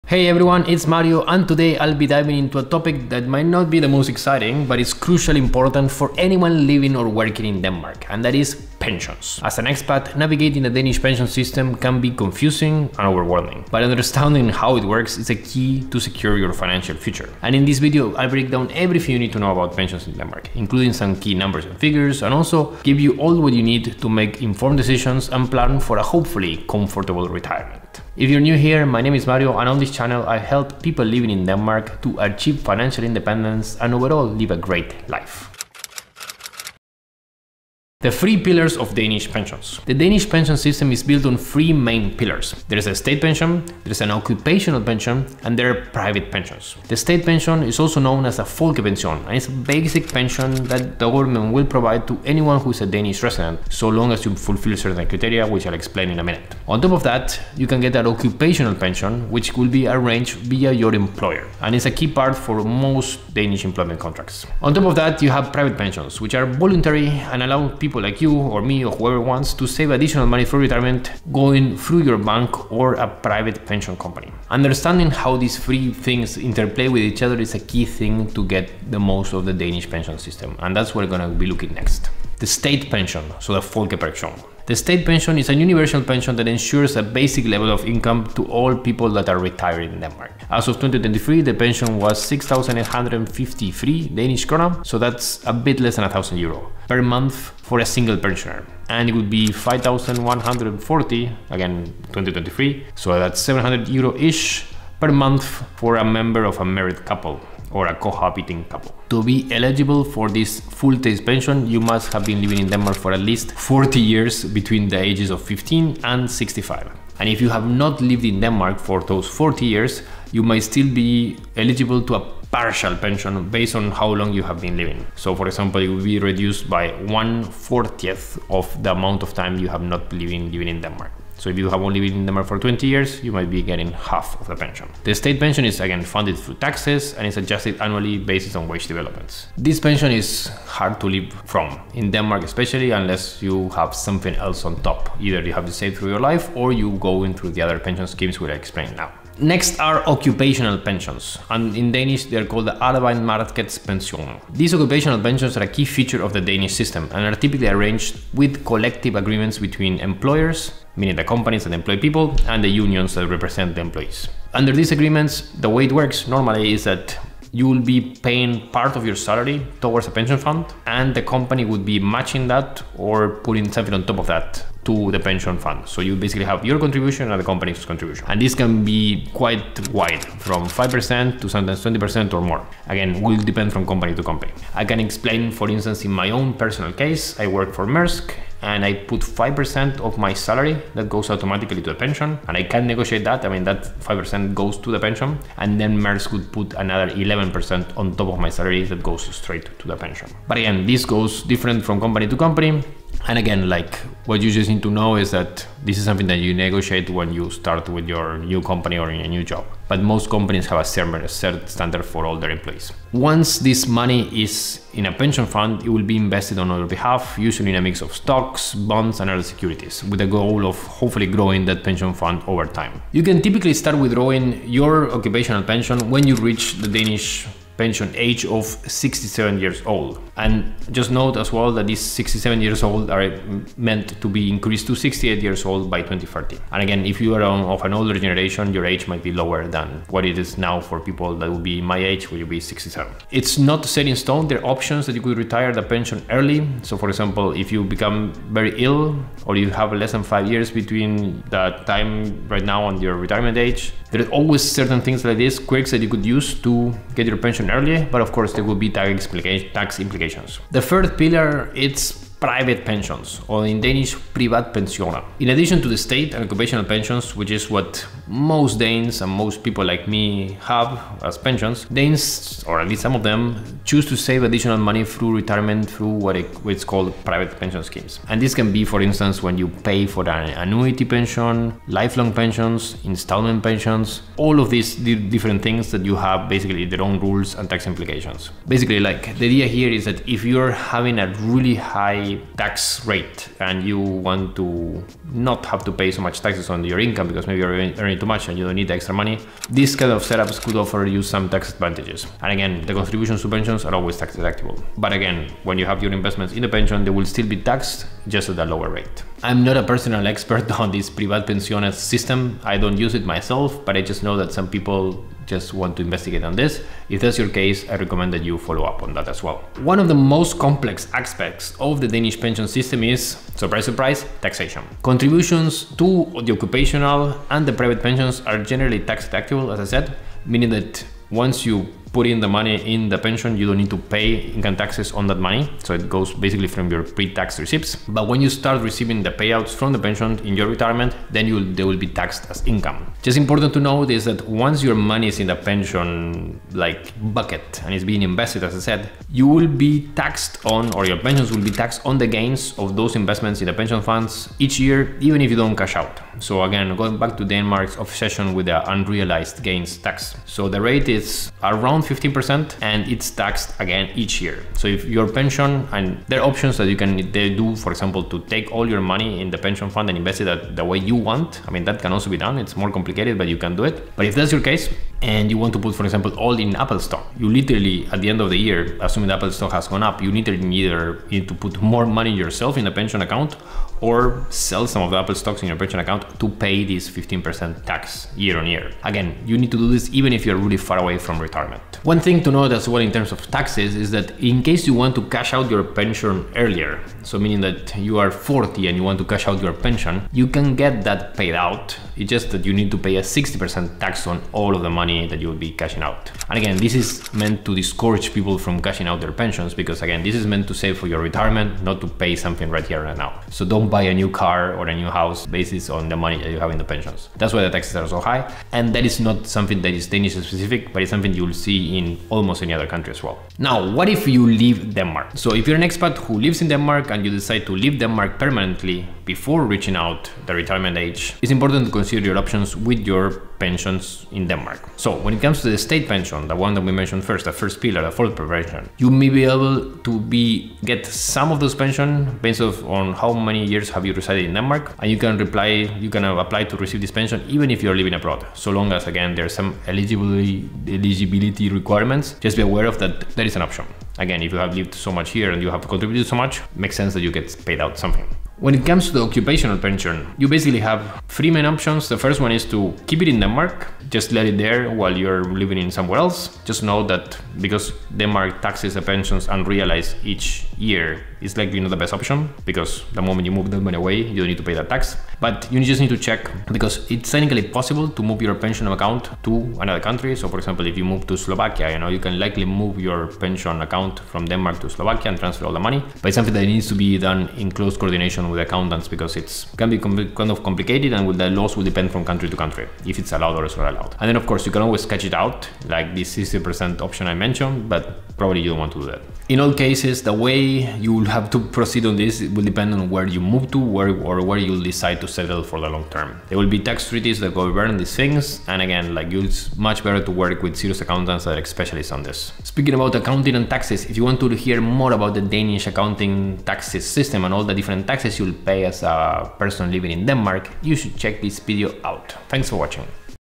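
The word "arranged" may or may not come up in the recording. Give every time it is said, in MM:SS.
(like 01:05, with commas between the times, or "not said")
00:59, 02:37.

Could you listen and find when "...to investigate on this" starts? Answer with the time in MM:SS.
05:15.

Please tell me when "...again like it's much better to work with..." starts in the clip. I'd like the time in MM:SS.
08:28.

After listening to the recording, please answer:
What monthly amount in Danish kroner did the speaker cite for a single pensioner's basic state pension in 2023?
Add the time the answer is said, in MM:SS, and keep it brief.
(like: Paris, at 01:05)
6,853 kroner, at 01:32.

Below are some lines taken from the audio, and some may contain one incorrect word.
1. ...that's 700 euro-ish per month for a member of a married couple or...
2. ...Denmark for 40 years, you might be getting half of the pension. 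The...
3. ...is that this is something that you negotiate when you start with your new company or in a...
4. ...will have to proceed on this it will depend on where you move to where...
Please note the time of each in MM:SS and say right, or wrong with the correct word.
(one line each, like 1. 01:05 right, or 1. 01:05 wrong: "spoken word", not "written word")
1. 01:43 right
2. 02:12 wrong: "20", not "40"
3. 03:25 right
4. 08:21 right.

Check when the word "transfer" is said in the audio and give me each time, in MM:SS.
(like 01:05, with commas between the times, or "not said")
08:05.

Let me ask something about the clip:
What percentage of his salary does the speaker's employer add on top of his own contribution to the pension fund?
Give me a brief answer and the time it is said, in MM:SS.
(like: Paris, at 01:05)
11%, at 03:17.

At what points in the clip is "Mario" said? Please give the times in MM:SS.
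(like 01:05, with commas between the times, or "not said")
00:00, 00:29.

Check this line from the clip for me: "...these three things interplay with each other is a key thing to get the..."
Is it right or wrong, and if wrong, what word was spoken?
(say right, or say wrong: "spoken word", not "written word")
right.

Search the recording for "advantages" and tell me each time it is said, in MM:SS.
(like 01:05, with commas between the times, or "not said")
05:01.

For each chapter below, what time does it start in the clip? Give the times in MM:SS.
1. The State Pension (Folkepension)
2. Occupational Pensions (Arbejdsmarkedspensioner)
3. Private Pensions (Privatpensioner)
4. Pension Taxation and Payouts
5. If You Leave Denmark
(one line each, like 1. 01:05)
1. 01:22
2. 02:29
3. 04:20
4. 05:19
5. 07:03.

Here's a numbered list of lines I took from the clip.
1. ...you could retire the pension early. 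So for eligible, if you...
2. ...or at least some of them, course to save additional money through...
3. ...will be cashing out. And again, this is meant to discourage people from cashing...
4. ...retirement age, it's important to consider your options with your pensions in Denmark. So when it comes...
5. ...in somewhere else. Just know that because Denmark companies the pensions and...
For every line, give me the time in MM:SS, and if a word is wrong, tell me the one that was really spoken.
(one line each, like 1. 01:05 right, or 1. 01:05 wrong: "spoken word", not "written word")
1. 04:05 wrong: "example", not "eligible"
2. 04:32 wrong: "choose", not "course"
3. 06:45 right
4. 07:10 right
5. 07:45 wrong: "taxes", not "companies".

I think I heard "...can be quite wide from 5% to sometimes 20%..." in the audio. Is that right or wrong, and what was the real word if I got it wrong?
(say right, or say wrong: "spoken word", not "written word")
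right.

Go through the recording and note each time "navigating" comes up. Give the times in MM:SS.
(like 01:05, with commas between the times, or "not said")
00:10.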